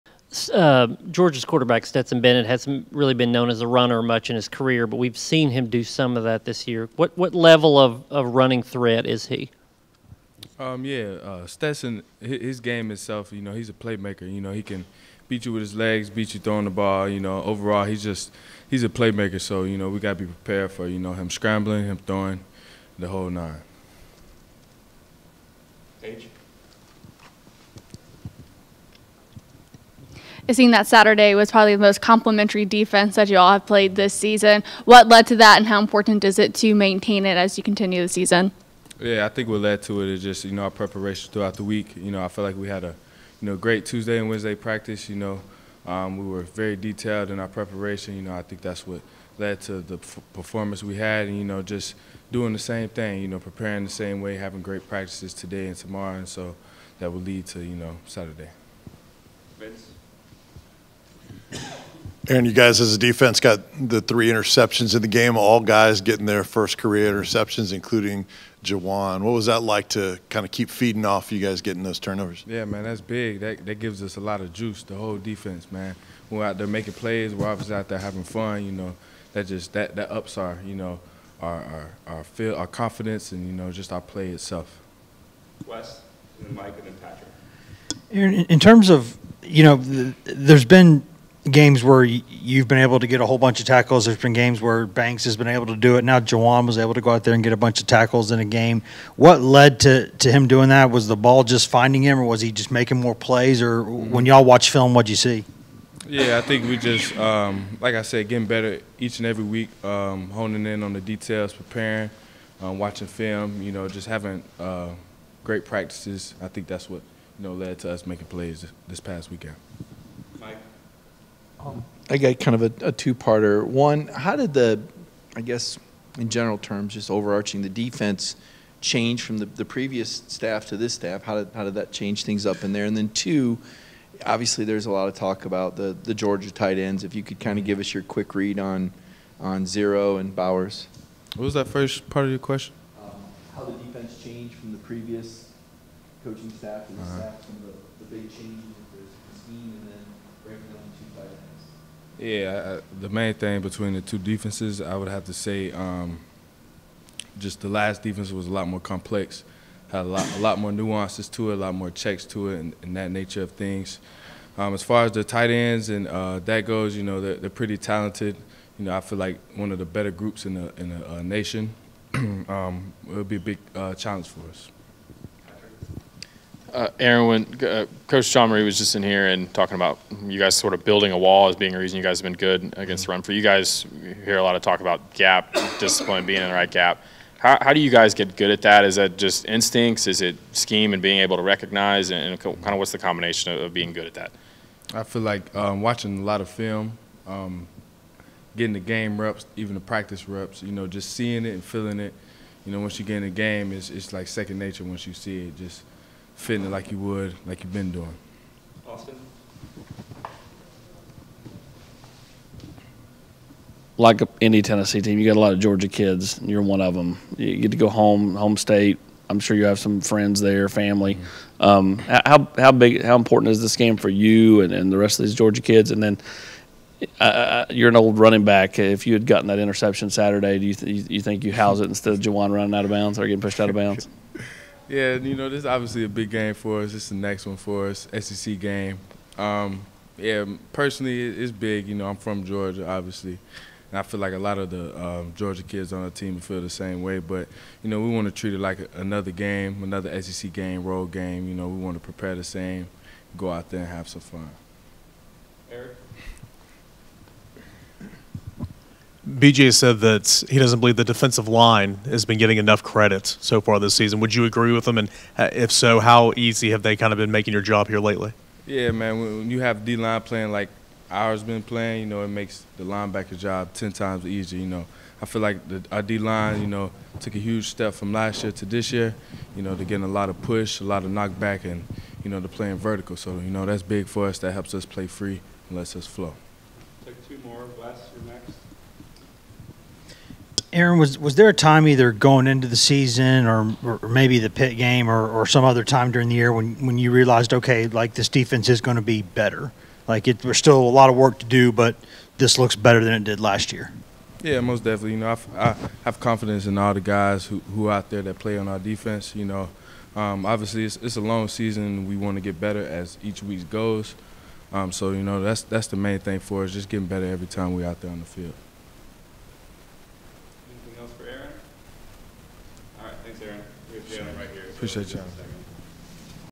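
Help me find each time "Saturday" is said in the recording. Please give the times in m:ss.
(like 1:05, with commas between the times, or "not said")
0:30, 0:58, 3:50.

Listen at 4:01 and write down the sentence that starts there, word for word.
You know, I'm from Georgia, obviously.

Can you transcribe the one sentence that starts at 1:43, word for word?
Or when y'all watch film, what'd you see?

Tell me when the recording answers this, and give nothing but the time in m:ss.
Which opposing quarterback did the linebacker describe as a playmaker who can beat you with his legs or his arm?
0:01.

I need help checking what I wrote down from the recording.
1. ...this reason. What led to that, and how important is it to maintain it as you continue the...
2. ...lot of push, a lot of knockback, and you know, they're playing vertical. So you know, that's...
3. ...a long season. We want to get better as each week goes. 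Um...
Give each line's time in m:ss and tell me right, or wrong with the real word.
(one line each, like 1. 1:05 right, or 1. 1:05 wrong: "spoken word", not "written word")
1. 0:33 wrong: "season", not "reason"
2. 4:40 right
3. 5:11 right.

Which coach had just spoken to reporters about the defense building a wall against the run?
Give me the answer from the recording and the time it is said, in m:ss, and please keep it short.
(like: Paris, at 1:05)
Coach Jean-Mary, at 2:58.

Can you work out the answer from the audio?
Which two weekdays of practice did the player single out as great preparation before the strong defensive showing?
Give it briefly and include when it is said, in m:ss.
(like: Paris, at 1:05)
Tuesday and Wednesday, at 0:43.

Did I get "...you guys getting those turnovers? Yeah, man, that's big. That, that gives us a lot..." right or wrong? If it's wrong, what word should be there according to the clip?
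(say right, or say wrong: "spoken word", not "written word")
right.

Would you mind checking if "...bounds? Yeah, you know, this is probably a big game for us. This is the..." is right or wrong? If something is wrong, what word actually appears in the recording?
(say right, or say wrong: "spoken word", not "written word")
wrong: "obviously", not "probably".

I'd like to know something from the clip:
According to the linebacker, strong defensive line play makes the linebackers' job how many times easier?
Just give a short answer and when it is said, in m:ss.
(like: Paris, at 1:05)
10 times, at 4:33.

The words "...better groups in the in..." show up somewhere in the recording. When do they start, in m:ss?
2:49.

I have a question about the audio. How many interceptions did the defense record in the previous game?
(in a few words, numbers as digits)
3.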